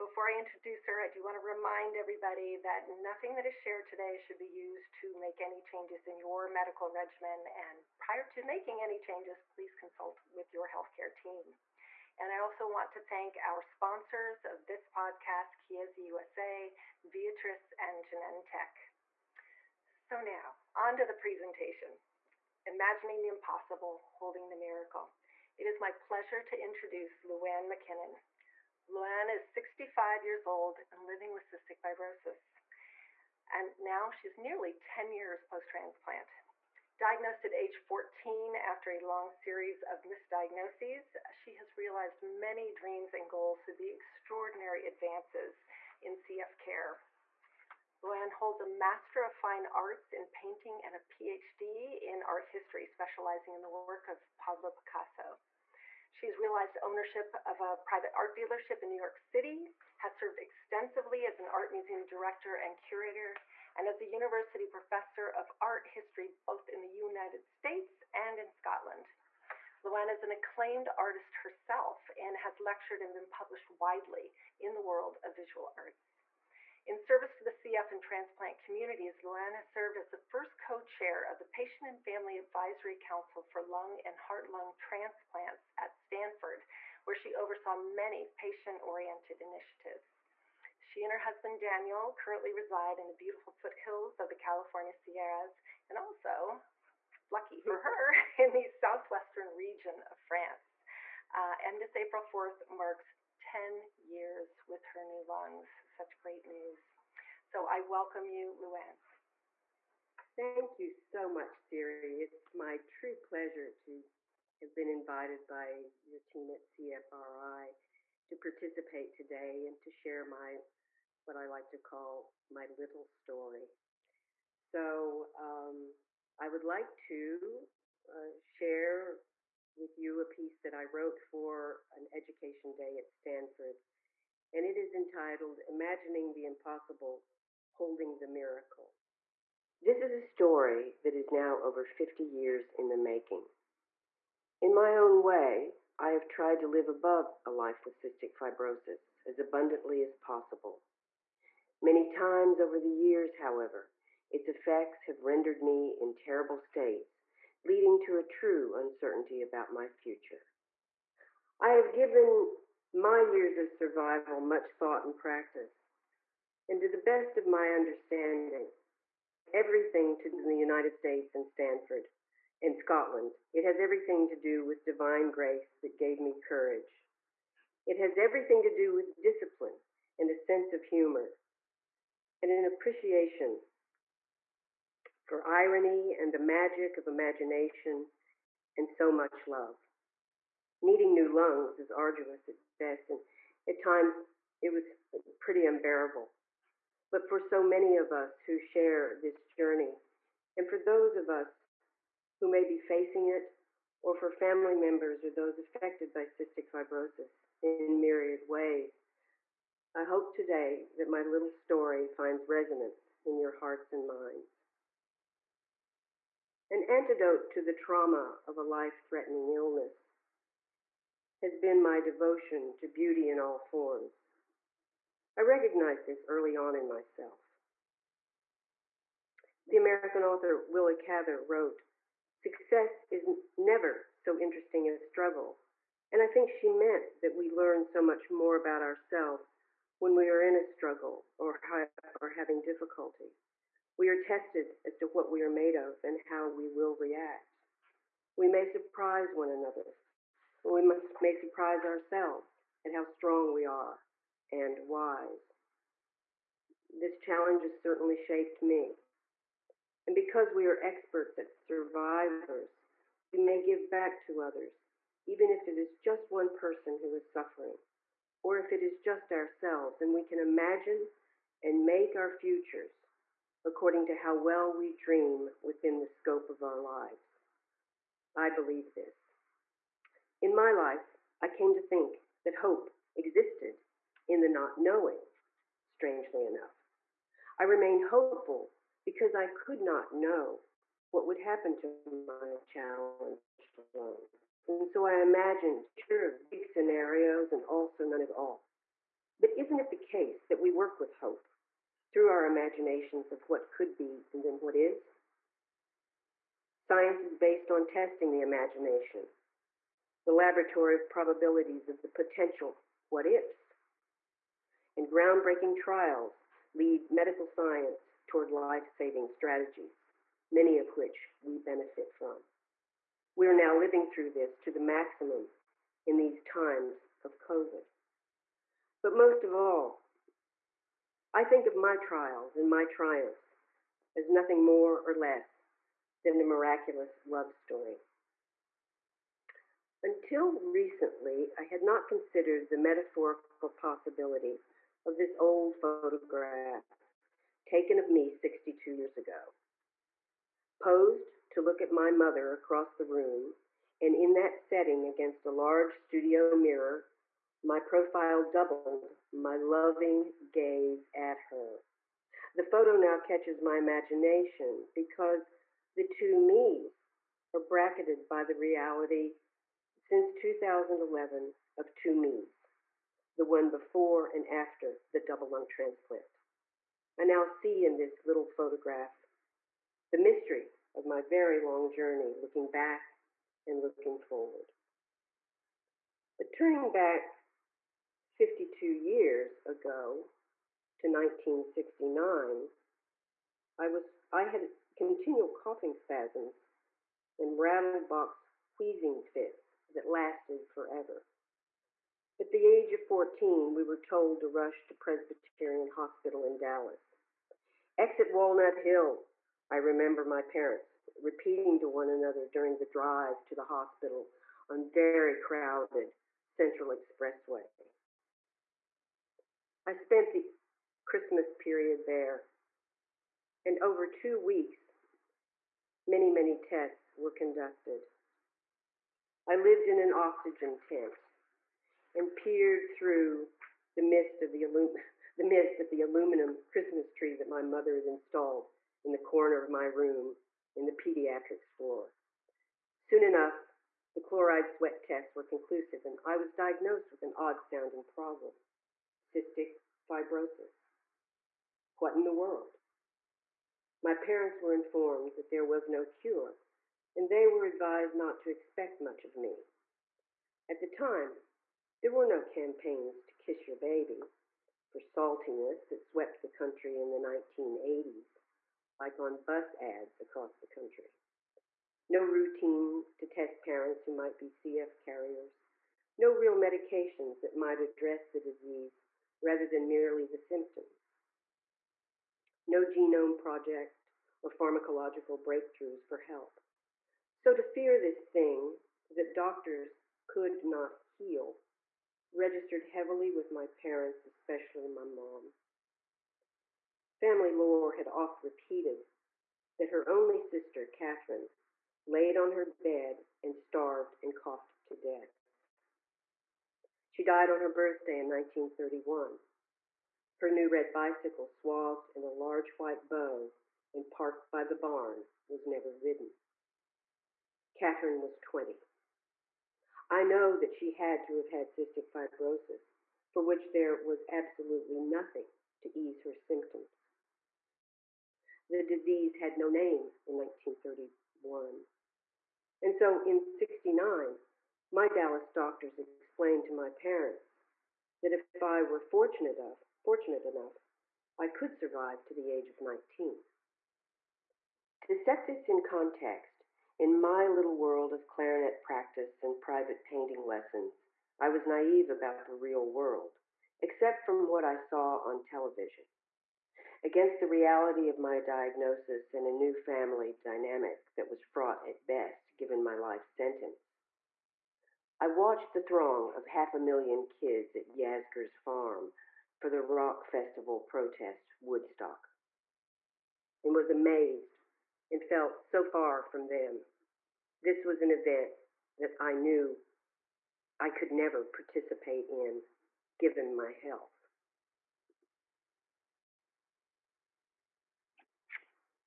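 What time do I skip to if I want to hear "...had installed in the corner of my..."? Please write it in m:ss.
7:17.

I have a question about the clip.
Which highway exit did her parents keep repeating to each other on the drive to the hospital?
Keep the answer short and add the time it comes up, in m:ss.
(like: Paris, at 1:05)
Walnut Hill, at 6:47.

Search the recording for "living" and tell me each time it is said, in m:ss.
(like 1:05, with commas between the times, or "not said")
0:31, 5:23.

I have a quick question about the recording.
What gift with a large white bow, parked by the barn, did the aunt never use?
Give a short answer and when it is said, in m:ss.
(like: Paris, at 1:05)
red bicycle, at 8:30.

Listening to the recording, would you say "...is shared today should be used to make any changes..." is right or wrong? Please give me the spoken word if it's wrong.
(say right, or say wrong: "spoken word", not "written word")
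right.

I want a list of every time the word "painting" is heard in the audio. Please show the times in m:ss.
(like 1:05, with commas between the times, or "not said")
0:50, 9:10.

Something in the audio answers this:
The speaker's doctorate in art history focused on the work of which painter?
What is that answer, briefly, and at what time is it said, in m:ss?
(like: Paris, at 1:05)
Pablo Picasso, at 0:54.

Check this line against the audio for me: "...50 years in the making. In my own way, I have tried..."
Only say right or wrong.
right.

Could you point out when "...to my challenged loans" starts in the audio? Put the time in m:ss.
4:51.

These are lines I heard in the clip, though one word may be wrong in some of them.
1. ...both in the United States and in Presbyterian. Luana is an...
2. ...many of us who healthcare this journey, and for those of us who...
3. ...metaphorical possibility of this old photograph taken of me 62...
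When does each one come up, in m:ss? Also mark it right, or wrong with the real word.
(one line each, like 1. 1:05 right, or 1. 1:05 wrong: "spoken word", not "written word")
1. 1:06 wrong: "Scotland", not "Presbyterian"
2. 3:17 wrong: "share", not "healthcare"
3. 5:42 right.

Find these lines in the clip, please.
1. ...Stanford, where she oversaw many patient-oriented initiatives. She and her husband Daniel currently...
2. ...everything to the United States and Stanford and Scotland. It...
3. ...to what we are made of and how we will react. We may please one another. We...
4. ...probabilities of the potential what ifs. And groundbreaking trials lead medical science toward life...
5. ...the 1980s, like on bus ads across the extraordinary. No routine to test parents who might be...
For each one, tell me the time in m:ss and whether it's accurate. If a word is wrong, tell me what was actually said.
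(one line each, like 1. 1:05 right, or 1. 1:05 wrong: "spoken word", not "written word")
1. 1:25 right
2. 2:49 right
3. 4:04 wrong: "surprise", not "please"
4. 5:11 right
5. 7:47 wrong: "country", not "extraordinary".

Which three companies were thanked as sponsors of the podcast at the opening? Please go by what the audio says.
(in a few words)
Chiesi USA, Viatris, and Genentech.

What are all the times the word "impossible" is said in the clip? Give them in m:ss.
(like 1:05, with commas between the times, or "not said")
0:23, 2:16.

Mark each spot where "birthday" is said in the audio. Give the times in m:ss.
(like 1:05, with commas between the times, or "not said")
8:27.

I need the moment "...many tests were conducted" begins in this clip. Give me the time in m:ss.
7:06.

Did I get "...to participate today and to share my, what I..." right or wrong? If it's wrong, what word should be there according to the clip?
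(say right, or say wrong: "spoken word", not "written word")
right.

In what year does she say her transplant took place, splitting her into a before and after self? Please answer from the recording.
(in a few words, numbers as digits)
2011.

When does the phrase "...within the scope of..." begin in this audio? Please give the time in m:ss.
4:35.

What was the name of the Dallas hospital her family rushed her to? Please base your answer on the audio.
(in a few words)
Presbyterian Hospital.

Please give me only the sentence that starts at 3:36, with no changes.
An antidote to the trauma of a life threatening illness has been my devotion to beauty in all forms.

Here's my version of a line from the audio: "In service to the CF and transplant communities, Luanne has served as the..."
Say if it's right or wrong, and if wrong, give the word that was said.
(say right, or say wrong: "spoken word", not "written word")
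right.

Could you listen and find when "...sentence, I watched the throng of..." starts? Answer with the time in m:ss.
9:23.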